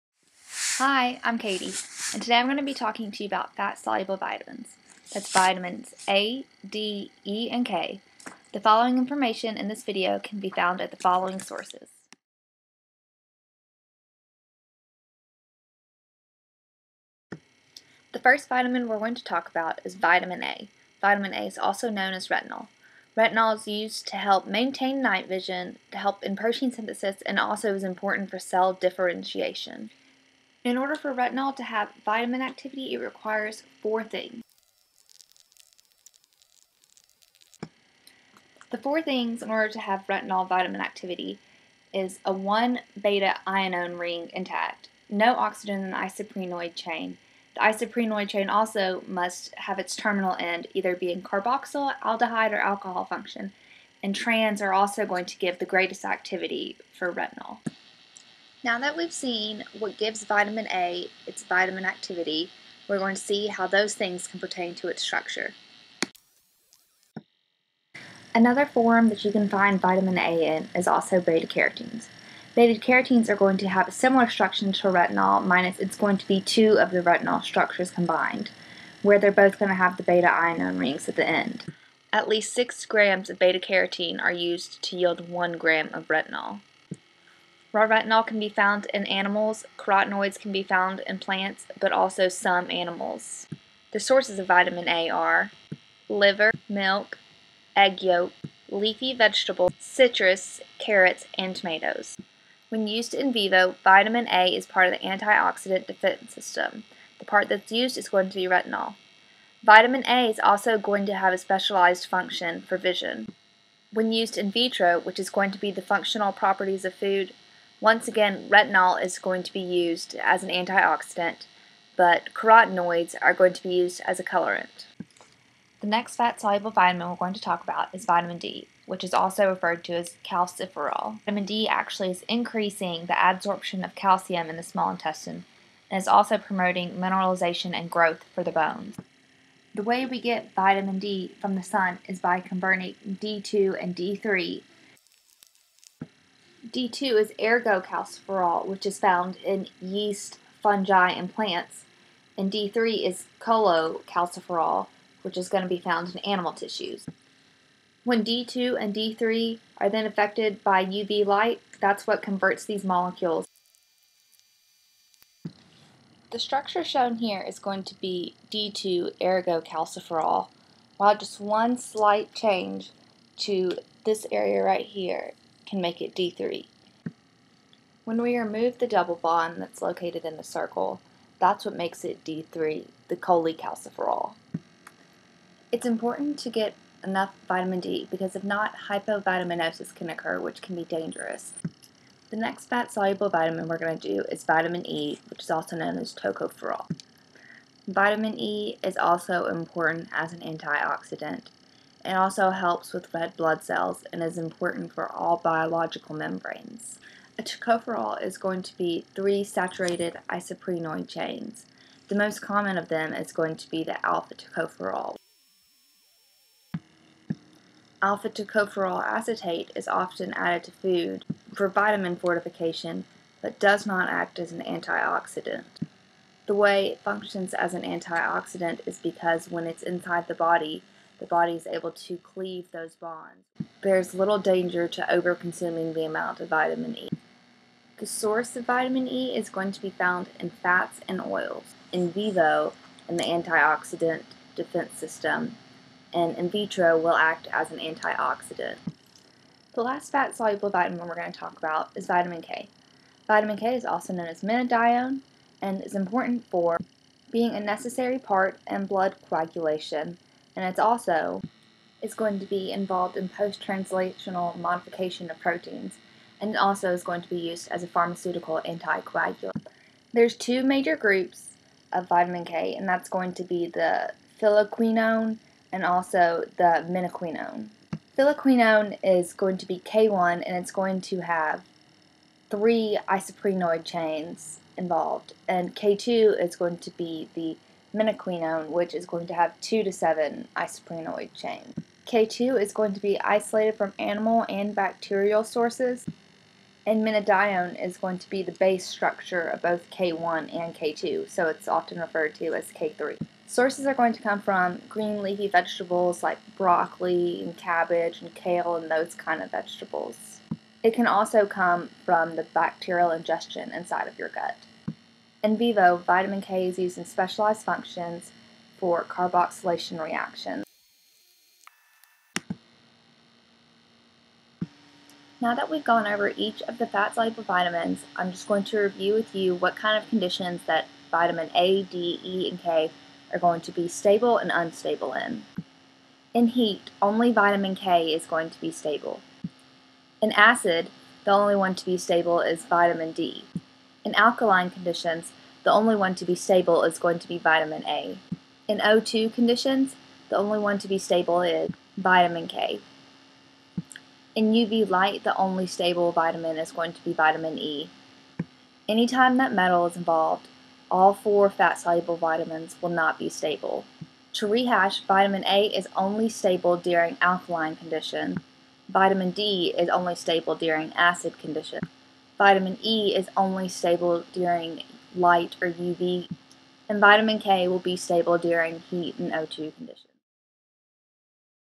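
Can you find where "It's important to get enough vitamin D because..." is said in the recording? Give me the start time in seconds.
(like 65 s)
185 s.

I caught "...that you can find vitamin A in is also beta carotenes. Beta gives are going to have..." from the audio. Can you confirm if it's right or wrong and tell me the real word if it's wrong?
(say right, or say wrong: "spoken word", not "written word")
wrong: "carotenes", not "gives".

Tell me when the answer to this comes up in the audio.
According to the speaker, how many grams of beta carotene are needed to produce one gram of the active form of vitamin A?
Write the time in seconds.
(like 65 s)
82 s.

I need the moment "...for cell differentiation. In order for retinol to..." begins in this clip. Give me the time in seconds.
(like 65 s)
28 s.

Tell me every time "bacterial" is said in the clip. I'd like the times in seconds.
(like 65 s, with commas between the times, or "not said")
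294 s, 312 s.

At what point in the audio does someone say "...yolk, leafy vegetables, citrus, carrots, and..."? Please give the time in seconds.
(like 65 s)
98 s.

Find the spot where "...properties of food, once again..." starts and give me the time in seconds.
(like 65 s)
116 s.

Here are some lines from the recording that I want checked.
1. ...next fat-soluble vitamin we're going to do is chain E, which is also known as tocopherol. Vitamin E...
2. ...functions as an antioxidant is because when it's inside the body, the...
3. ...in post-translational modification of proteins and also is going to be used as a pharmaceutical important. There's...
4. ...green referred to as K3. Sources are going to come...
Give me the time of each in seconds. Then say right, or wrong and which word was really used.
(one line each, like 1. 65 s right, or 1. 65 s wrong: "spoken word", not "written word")
1. 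192 s wrong: "vitamin", not "chain"
2. 227 s right
3. 263 s wrong: "anticoagulant", not "important"
4. 301 s wrong: "often", not "green".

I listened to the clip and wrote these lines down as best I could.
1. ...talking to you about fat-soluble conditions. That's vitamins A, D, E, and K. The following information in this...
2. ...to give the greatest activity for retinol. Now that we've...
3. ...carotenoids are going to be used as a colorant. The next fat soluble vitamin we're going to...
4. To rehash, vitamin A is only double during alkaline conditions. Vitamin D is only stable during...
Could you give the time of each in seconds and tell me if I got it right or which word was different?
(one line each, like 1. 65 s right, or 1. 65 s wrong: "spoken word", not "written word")
1. 2 s wrong: "vitamins", not "conditions"
2. 55 s right
3. 122 s right
4. 364 s wrong: "stable", not "double".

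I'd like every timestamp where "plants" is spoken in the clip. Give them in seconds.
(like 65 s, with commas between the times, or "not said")
91 s, 151 s.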